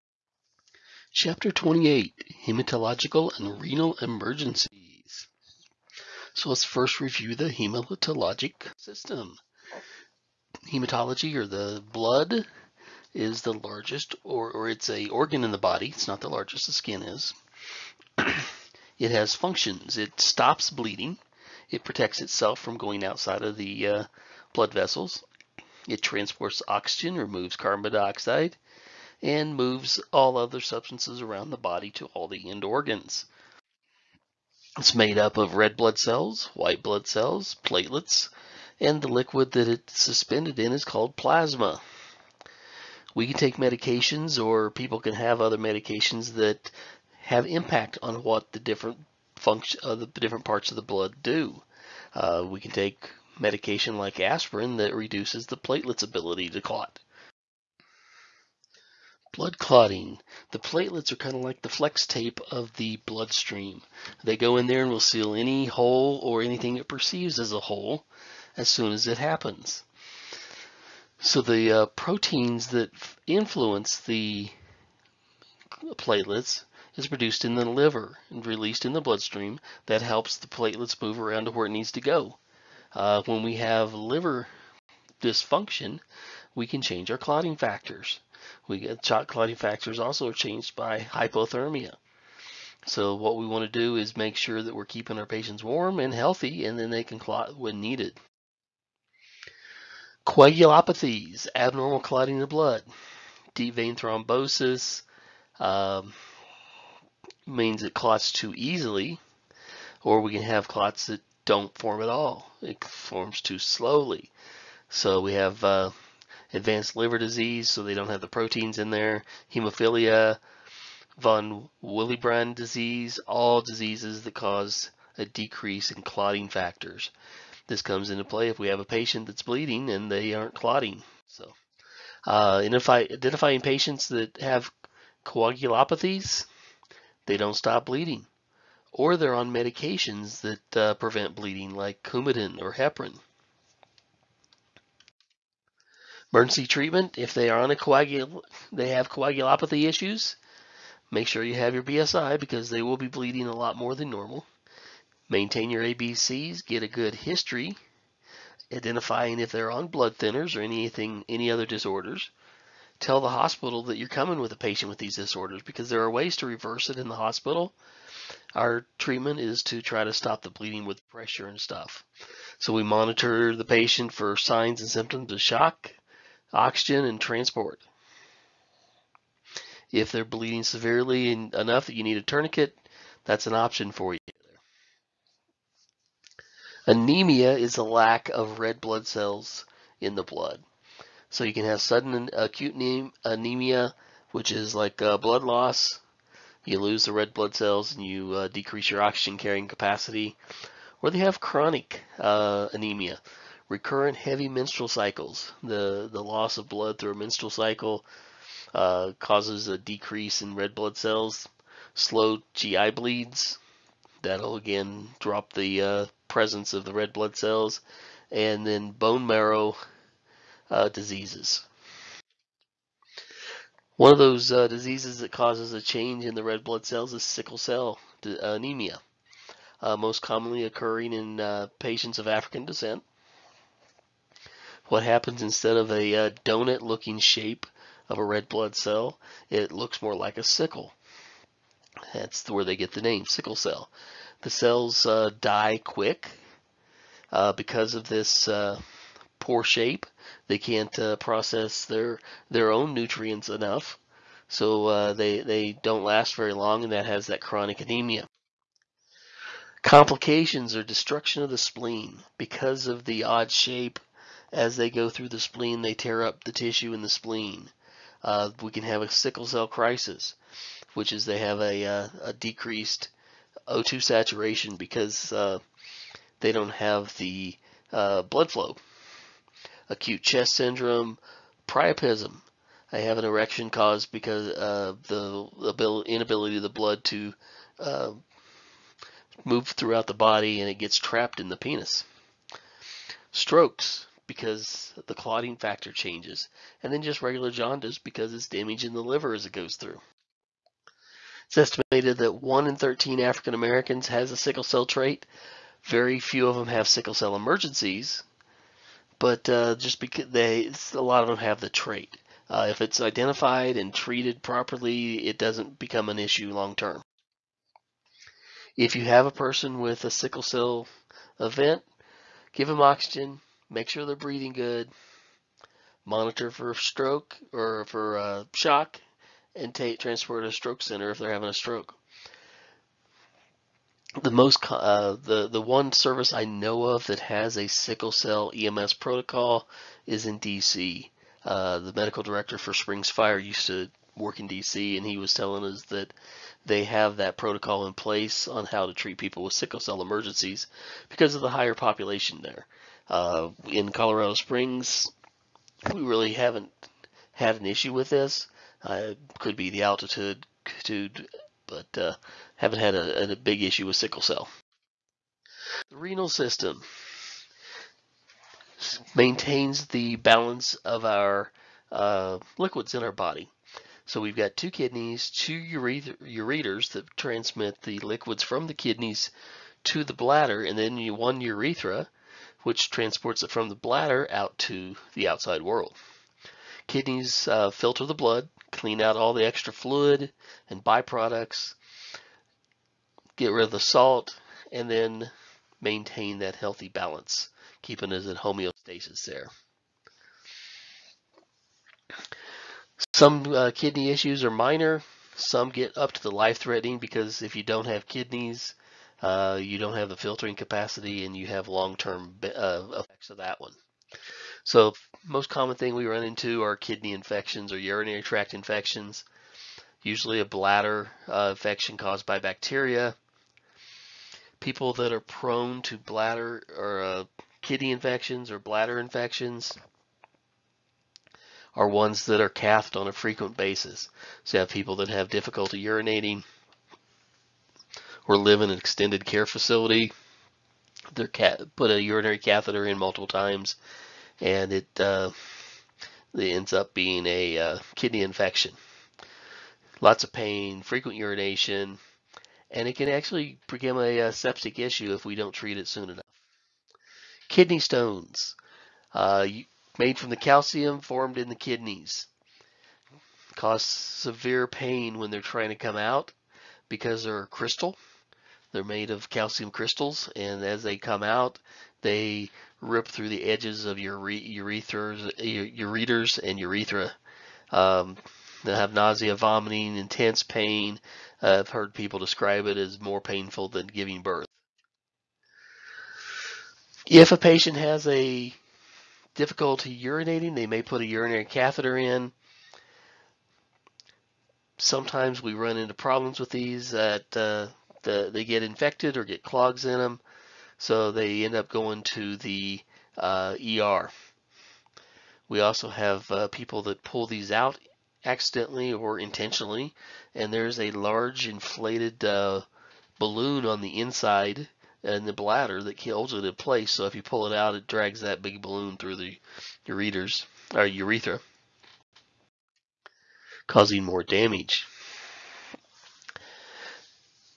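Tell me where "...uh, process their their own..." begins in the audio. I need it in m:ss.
4:10.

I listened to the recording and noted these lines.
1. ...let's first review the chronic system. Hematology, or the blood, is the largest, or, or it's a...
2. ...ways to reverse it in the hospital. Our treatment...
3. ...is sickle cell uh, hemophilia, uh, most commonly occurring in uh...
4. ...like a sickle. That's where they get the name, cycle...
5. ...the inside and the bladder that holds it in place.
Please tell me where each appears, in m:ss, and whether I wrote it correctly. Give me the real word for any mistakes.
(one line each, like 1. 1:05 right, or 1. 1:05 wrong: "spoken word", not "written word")
1. 0:06 wrong: "hematologic", not "chronic"
2. 2:46 right
3. 3:47 wrong: "anemia", not "hemophilia"
4. 4:00 wrong: "sickle", not "cycle"
5. 8:33 right.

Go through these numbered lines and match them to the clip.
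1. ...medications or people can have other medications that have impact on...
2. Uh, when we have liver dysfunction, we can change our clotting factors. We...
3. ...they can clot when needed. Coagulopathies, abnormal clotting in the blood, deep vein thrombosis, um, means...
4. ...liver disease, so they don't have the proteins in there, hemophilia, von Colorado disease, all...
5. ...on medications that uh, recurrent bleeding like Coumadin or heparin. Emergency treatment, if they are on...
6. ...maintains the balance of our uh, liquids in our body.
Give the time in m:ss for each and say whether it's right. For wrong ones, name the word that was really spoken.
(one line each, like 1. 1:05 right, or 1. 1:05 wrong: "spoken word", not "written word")
1. 0:43 right
2. 1:22 right
3. 1:36 right
4. 1:56 wrong: "Willebrand", not "Colorado"
5. 2:19 wrong: "prevent", not "recurrent"
6. 6:09 right.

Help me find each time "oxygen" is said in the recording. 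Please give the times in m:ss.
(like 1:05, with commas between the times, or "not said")
0:26, 2:56, 3:19, 5:22.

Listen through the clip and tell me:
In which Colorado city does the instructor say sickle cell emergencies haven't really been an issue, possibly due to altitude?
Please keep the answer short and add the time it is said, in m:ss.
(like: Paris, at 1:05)
Colorado Springs, at 5:53.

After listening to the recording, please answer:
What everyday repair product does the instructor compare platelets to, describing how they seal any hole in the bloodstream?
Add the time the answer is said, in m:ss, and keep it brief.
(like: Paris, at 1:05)
Flex tape, at 1:01.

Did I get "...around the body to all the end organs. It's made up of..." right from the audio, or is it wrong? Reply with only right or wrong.
right.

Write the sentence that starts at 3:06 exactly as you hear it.
Anemia is a lack of red blood cells in the blood.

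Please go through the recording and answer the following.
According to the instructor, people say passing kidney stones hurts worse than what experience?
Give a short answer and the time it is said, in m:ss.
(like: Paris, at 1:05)
Giving birth, at 8:03.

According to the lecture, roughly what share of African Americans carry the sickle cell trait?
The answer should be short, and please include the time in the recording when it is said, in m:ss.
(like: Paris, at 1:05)
1 in 13, at 5:02.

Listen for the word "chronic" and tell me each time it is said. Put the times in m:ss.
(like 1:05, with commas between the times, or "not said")
3:21, 4:17.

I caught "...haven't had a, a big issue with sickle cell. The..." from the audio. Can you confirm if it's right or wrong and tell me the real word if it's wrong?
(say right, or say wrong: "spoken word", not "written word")
right.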